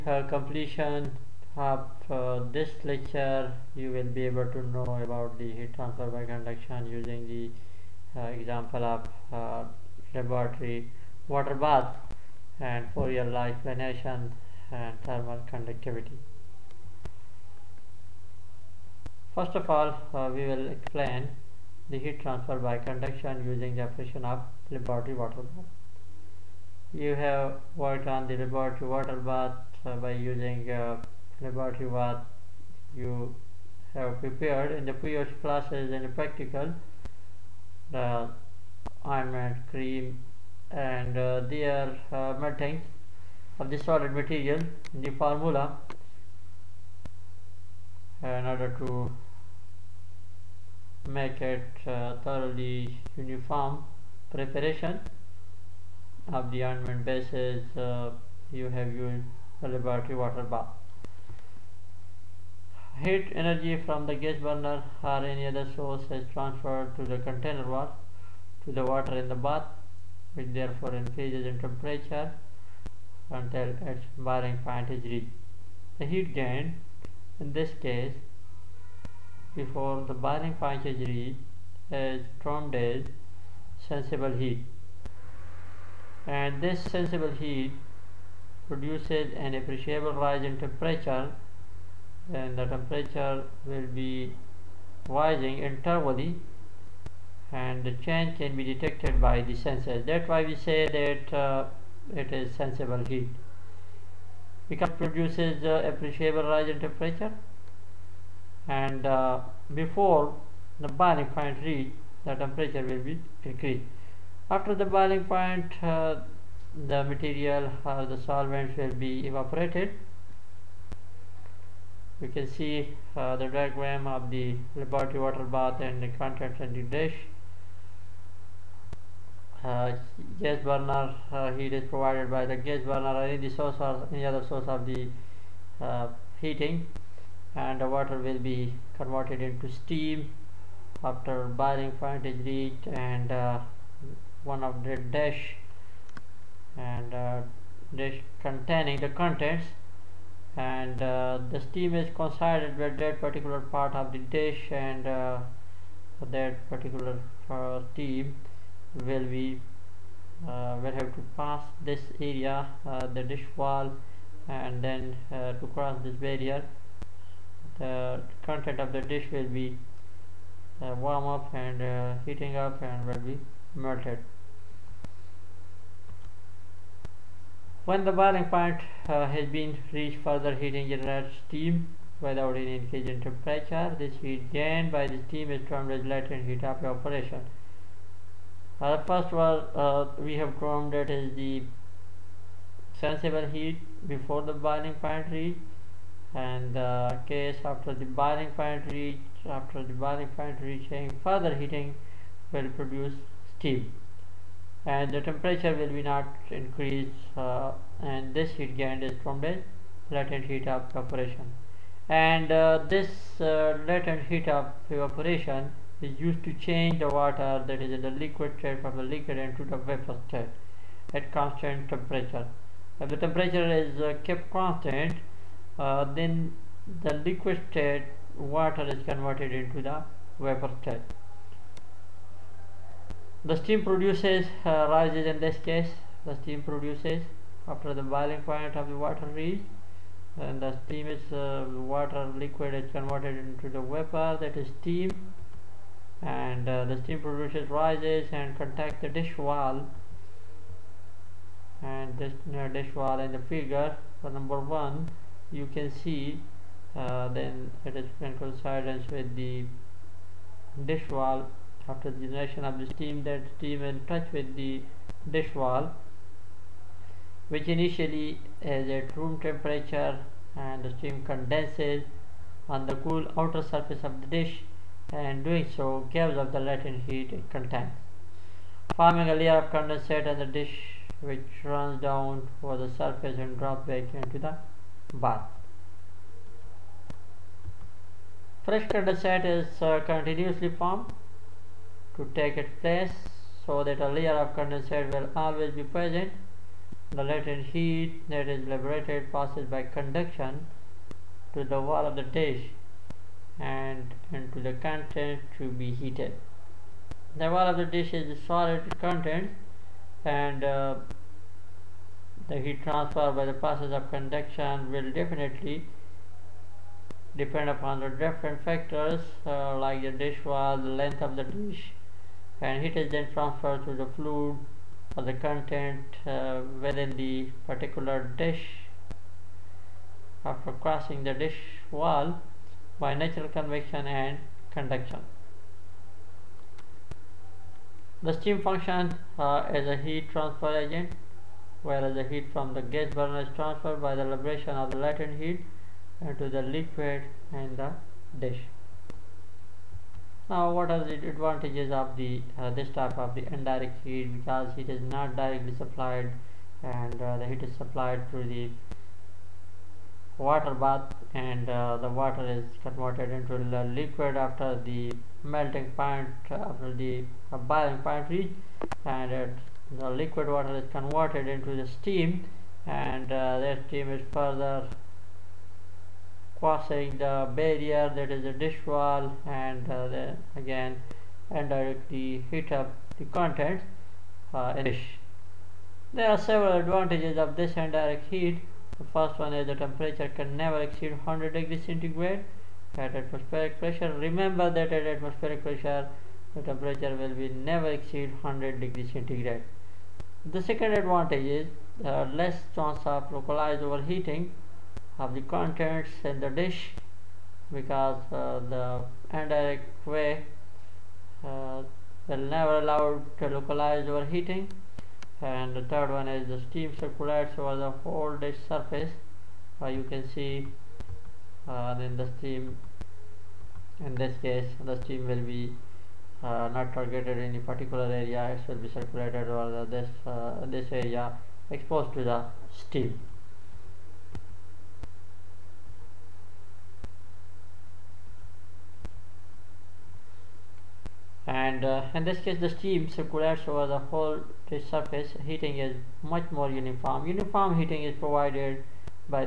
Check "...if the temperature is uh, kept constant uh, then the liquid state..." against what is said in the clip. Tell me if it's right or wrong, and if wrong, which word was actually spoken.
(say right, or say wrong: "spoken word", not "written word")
right.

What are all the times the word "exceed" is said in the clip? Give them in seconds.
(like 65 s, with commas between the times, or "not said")
390 s, 397 s.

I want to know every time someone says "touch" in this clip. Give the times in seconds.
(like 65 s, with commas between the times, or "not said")
264 s.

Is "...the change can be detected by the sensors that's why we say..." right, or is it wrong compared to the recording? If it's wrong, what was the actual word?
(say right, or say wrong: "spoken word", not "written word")
right.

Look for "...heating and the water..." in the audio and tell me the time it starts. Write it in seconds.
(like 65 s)
136 s.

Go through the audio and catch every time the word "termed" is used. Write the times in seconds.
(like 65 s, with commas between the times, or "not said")
82 s, 185 s, 190 s.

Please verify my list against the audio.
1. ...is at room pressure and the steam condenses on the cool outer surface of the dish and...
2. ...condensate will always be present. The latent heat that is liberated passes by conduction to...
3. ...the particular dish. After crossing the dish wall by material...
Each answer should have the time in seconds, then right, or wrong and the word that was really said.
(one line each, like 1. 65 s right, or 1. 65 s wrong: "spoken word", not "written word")
1. 268 s wrong: "temperature", not "pressure"
2. 294 s right
3. 327 s wrong: "natural", not "material".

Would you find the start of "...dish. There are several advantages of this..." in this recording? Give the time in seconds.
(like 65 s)
384 s.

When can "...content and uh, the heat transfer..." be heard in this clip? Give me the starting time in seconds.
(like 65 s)
308 s.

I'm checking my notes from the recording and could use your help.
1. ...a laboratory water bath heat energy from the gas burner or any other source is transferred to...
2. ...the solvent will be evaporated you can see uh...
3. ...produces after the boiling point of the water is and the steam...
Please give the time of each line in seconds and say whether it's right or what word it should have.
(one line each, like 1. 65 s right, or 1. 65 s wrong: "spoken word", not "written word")
1. 59 s right
2. 118 s right
3. 236 s right.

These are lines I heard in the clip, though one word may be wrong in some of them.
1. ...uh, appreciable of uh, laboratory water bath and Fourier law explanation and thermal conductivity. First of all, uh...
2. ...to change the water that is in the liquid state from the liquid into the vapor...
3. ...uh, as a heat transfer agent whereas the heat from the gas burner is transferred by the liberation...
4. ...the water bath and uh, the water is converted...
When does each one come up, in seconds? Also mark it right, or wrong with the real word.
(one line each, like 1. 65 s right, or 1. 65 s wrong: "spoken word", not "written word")
1. 8 s wrong: "example", not "appreciable"
2. 216 s right
3. 339 s right
4. 358 s right.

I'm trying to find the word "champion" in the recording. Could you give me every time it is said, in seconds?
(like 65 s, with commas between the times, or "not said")
not said.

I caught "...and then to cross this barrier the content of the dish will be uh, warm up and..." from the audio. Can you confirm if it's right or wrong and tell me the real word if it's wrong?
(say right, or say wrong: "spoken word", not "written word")
right.